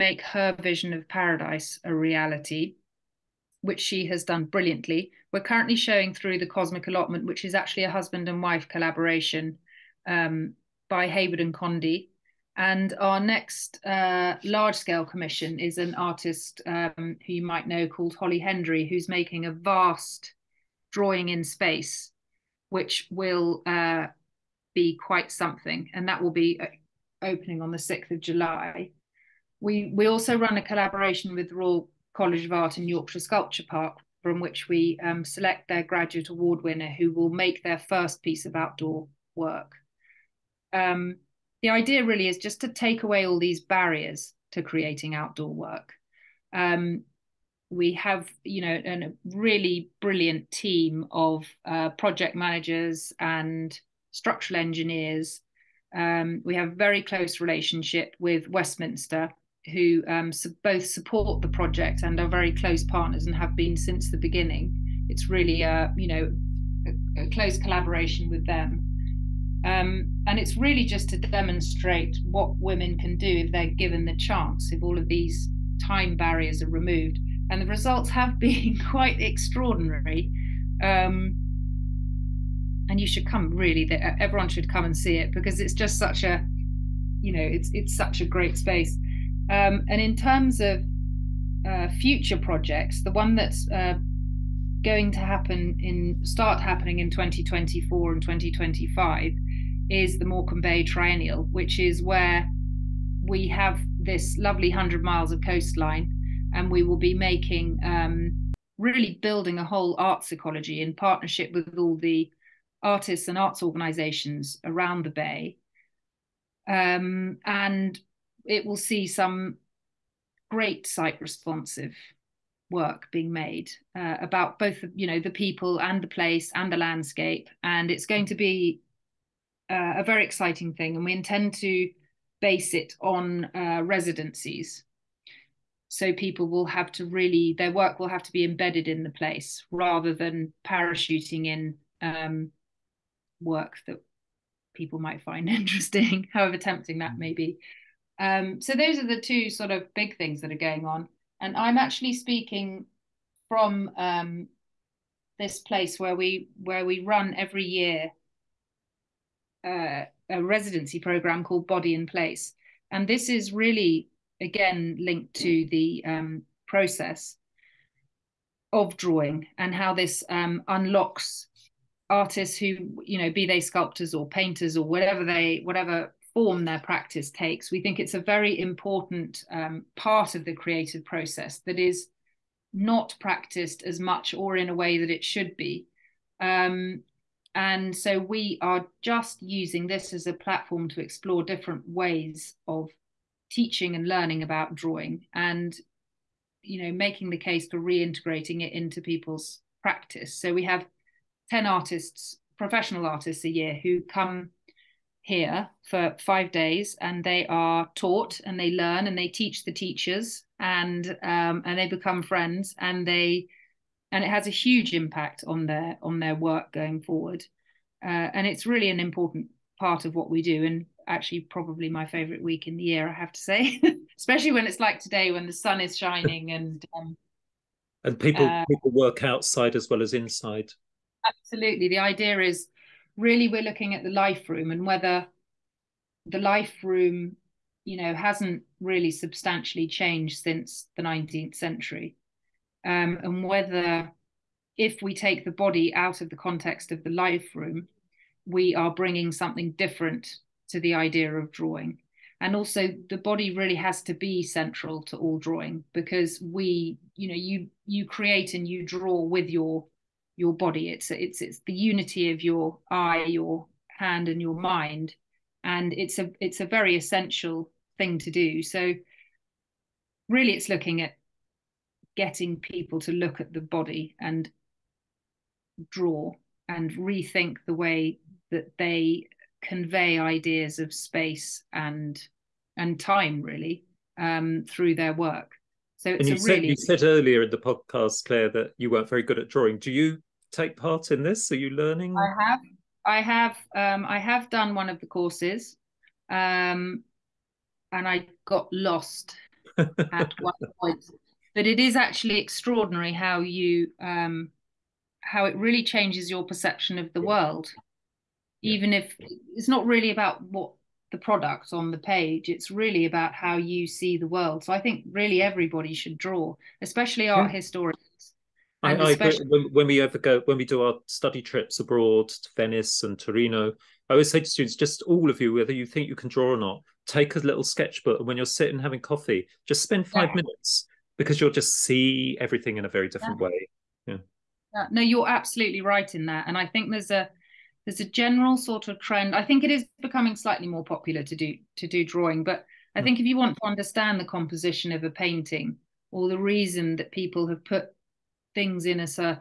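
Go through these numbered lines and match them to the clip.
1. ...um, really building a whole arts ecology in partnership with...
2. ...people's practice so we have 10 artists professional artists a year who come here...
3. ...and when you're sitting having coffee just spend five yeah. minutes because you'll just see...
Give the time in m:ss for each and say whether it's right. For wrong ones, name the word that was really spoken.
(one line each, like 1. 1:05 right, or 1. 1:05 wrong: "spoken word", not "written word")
1. 1:47 right
2. 3:19 right
3. 5:28 right.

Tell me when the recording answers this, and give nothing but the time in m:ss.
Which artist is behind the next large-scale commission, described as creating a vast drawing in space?
0:18.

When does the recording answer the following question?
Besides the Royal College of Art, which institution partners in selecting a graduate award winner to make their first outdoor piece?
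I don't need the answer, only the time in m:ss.
0:32.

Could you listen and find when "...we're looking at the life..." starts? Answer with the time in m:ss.
3:53.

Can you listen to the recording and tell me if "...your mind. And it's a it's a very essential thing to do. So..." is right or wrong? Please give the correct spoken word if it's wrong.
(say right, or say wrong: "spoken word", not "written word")
right.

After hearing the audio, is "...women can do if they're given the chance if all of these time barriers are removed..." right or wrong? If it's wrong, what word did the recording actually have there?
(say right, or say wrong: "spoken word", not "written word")
right.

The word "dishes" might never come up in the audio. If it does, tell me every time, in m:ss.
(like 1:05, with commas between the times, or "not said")
not said.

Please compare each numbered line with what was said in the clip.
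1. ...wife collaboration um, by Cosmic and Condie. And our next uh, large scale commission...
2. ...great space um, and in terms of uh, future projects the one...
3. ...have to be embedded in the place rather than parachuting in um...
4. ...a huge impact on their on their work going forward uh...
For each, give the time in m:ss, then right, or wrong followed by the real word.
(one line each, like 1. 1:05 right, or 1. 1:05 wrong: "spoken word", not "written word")
1. 0:08 wrong: "Heywood", not "Cosmic"
2. 1:28 right
3. 2:18 right
4. 3:34 right.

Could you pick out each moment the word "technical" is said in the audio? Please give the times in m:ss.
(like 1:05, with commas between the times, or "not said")
not said.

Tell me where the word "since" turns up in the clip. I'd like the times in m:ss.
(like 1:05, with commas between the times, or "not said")
1:03, 4:00.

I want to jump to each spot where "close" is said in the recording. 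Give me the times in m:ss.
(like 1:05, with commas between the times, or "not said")
0:57, 1:02, 1:07.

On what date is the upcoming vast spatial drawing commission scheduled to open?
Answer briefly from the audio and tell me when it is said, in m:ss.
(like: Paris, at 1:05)
6th of July, at 0:27.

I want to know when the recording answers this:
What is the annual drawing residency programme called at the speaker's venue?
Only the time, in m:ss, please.
2:41.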